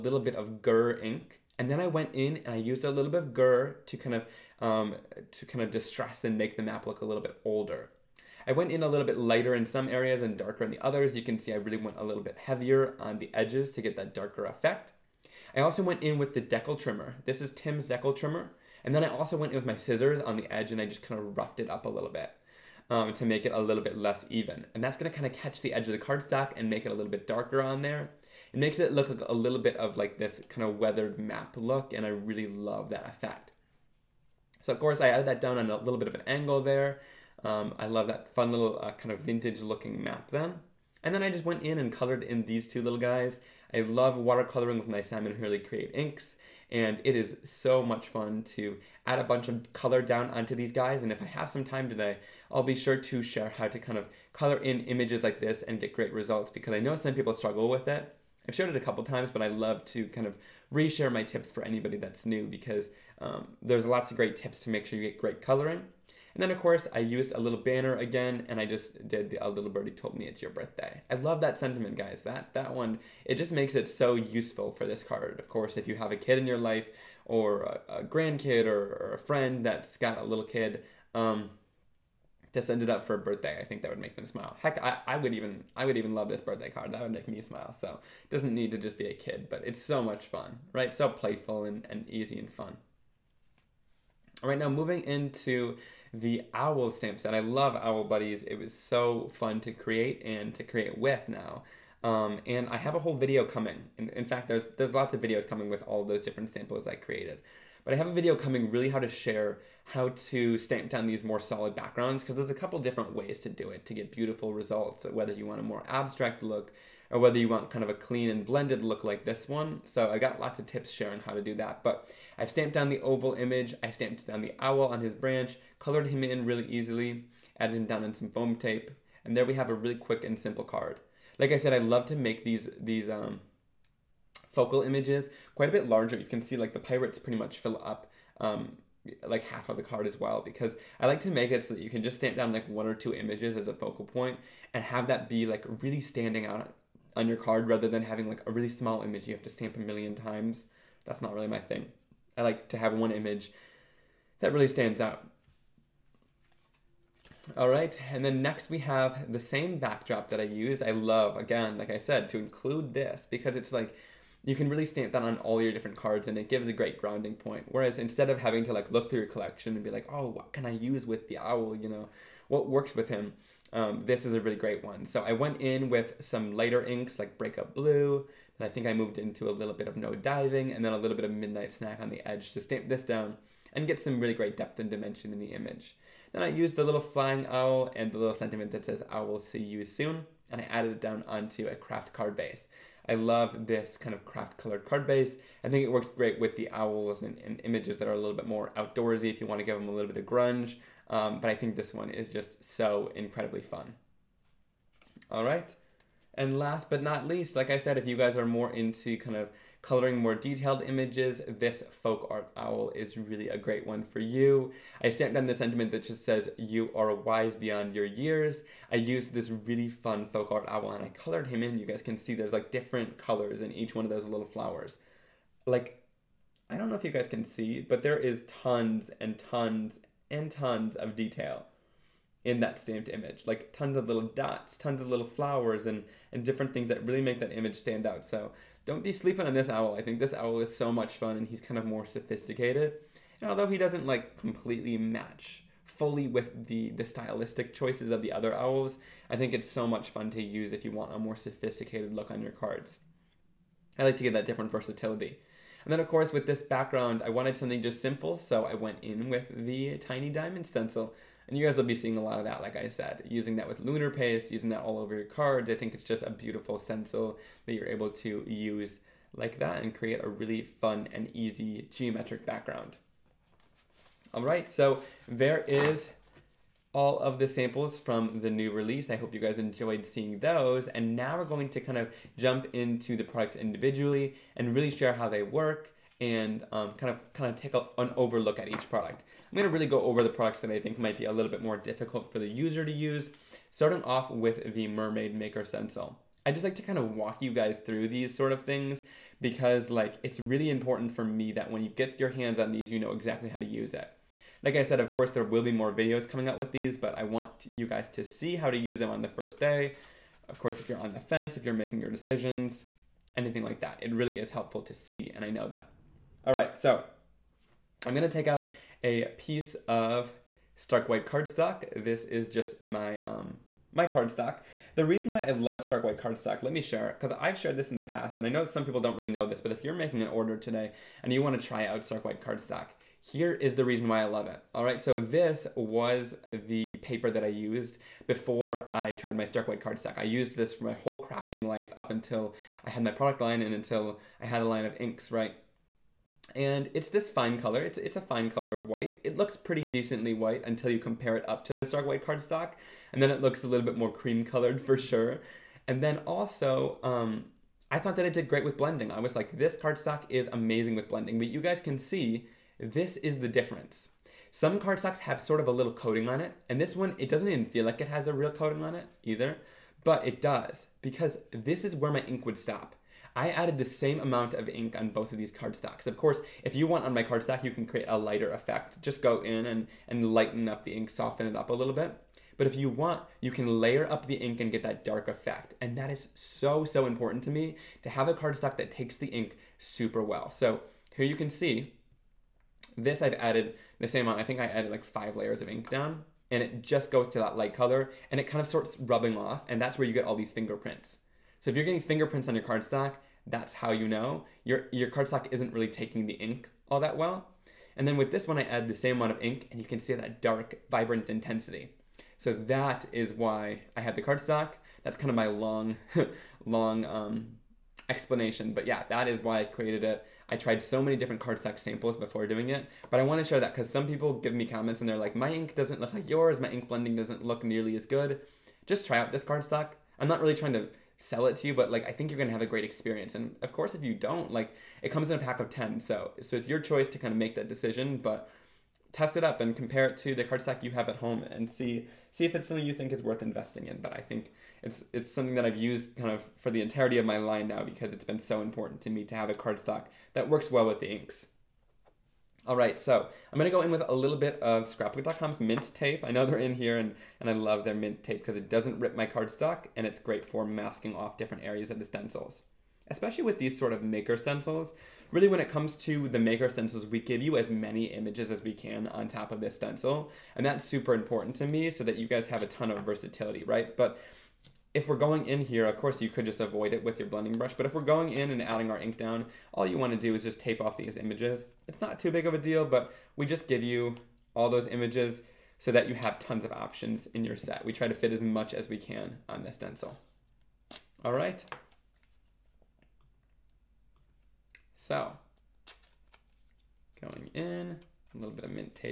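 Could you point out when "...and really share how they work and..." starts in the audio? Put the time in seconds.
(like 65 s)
284 s.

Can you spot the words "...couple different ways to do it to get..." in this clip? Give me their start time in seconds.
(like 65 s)
112 s.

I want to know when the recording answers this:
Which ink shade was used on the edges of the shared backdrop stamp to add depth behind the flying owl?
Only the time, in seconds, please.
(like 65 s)
181 s.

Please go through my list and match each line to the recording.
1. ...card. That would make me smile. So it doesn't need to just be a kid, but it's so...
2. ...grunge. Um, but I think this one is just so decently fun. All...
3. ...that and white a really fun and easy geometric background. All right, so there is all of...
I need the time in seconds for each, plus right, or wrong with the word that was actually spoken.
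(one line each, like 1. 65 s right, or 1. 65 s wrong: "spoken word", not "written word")
1. 86 s right
2. 200 s wrong: "incredibly", not "decently"
3. 269 s wrong: "create", not "white".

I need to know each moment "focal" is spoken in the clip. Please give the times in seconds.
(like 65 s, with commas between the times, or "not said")
134 s, 143 s.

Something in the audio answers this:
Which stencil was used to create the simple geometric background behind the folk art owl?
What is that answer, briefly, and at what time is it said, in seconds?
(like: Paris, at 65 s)
Tiny diamond stencil, at 259 s.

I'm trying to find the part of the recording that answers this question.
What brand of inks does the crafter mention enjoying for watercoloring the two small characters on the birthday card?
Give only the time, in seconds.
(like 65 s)
44 s.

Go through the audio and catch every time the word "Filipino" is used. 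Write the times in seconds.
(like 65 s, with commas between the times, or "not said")
not said.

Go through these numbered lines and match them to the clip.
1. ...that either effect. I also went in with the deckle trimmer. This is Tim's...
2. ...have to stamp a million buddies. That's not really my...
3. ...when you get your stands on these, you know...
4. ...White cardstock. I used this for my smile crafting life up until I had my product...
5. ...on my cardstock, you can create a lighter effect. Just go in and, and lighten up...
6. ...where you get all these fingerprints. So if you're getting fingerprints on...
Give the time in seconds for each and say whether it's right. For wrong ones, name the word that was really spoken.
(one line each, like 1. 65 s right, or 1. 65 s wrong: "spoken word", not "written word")
1. 13 s wrong: "darker", not "either"
2. 149 s wrong: "times", not "buddies"
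3. 301 s wrong: "hands", not "stands"
4. 339 s wrong: "whole", not "smile"
5. 377 s right
6. 399 s right.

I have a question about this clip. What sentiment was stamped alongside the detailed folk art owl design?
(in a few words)
You are wise beyond your years.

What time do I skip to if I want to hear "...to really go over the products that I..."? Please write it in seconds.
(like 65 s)
289 s.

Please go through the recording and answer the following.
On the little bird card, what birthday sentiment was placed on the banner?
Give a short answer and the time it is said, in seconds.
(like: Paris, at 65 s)
Little birdie told me, at 69 s.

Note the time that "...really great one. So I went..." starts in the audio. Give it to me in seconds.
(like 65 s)
174 s.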